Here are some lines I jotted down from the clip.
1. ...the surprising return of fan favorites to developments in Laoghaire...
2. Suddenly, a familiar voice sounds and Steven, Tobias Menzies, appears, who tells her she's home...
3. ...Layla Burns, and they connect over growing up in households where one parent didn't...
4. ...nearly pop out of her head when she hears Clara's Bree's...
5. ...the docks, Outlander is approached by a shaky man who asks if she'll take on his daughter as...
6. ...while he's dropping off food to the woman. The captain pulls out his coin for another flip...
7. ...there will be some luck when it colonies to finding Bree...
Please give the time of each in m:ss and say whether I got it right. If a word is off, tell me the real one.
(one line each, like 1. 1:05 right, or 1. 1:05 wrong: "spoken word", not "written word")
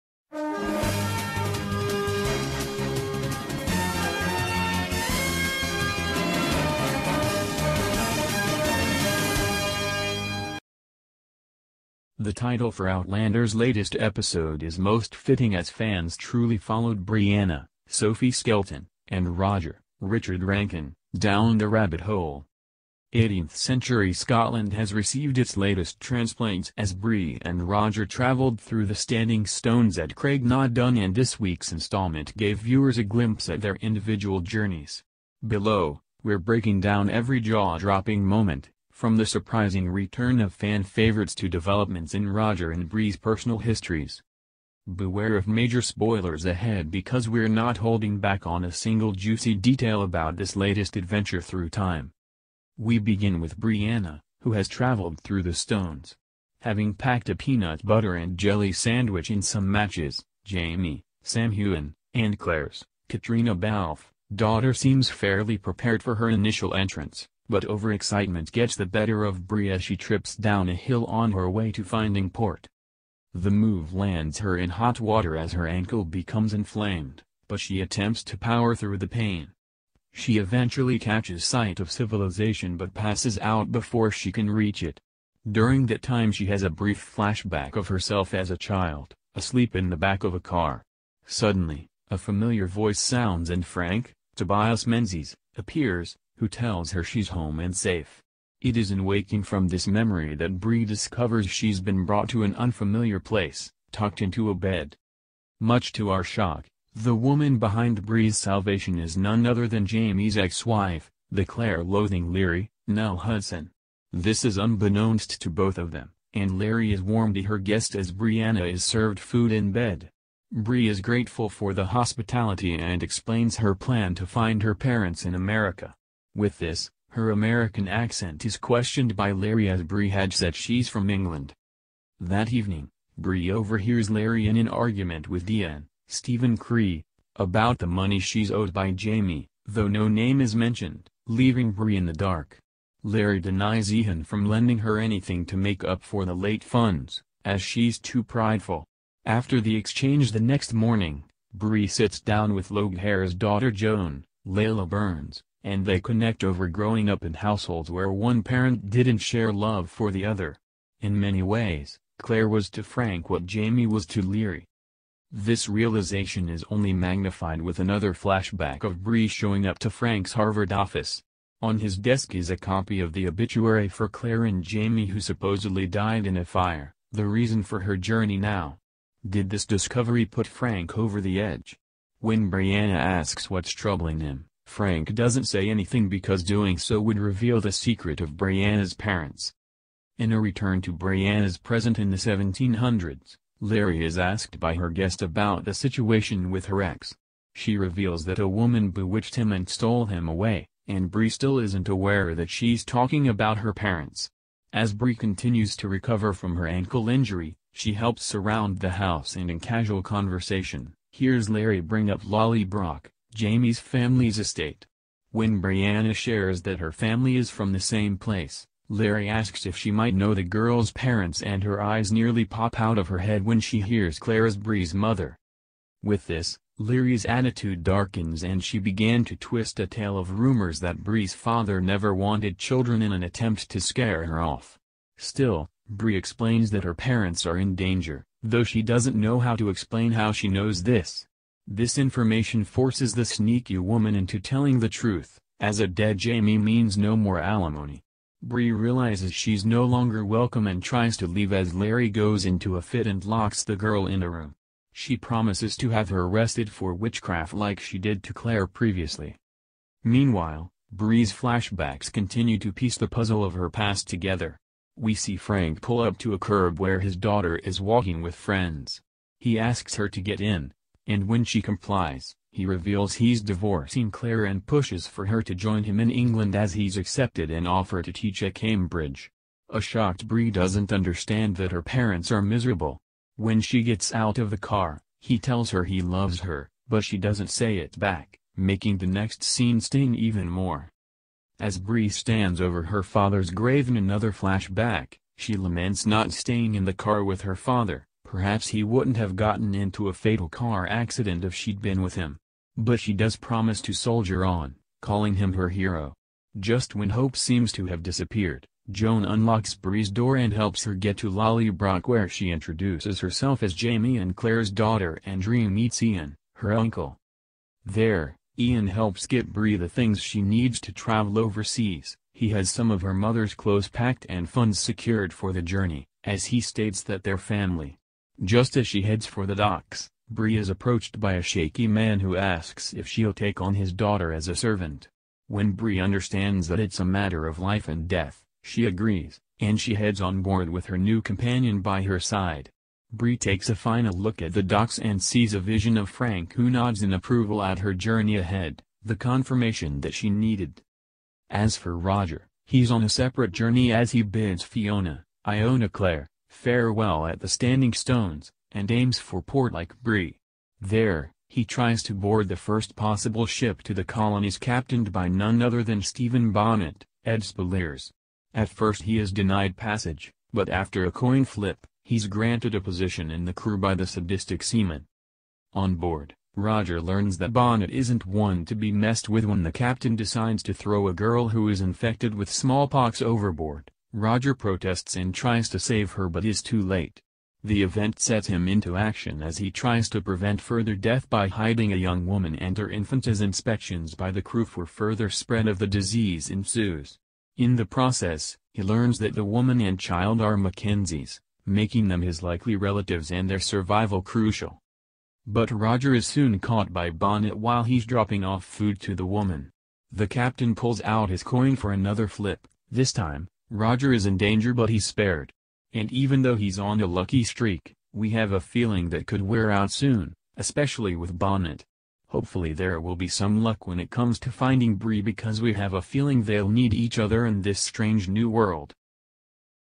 1. 0:39 wrong: "Roger", not "Laoghaire"
2. 1:31 wrong: "Frank", not "Steven"
3. 2:34 right
4. 3:42 right
5. 5:29 wrong: "Bree", not "Outlander"
6. 6:47 right
7. 7:02 wrong: "comes", not "colonies".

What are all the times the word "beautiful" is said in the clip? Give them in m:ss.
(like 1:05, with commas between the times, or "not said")
not said.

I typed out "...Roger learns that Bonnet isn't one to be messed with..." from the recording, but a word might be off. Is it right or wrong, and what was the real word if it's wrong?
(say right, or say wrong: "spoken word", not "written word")
right.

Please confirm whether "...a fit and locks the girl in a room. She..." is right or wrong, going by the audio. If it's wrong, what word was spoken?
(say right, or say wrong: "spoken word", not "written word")
right.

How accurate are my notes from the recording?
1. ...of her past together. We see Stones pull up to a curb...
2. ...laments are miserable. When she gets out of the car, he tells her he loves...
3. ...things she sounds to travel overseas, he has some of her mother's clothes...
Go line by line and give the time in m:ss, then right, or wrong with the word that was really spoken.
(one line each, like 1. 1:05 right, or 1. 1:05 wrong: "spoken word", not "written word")
1. 4:23 wrong: "Frank", not "Stones"
2. 4:41 wrong: "parents", not "laments"
3. 5:19 wrong: "needs", not "sounds".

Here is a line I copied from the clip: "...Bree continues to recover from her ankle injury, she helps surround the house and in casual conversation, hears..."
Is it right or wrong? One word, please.
right.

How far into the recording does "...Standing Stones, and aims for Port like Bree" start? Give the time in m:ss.
5:57.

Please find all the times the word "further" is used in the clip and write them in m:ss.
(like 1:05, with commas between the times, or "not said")
6:30, 6:34.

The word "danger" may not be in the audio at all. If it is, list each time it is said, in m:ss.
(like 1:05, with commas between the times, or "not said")
3:57, 6:54.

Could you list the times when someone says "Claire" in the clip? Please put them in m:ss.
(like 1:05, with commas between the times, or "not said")
1:02, 1:51, 2:42, 2:54, 4:18, 4:34, 5:14, 5:55.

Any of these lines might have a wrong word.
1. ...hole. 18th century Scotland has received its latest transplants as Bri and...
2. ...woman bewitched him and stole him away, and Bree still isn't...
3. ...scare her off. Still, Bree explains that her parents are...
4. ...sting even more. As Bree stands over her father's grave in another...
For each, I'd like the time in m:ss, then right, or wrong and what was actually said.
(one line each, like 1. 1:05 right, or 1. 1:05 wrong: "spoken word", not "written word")
1. 0:22 right
2. 3:18 right
3. 3:53 right
4. 4:49 right.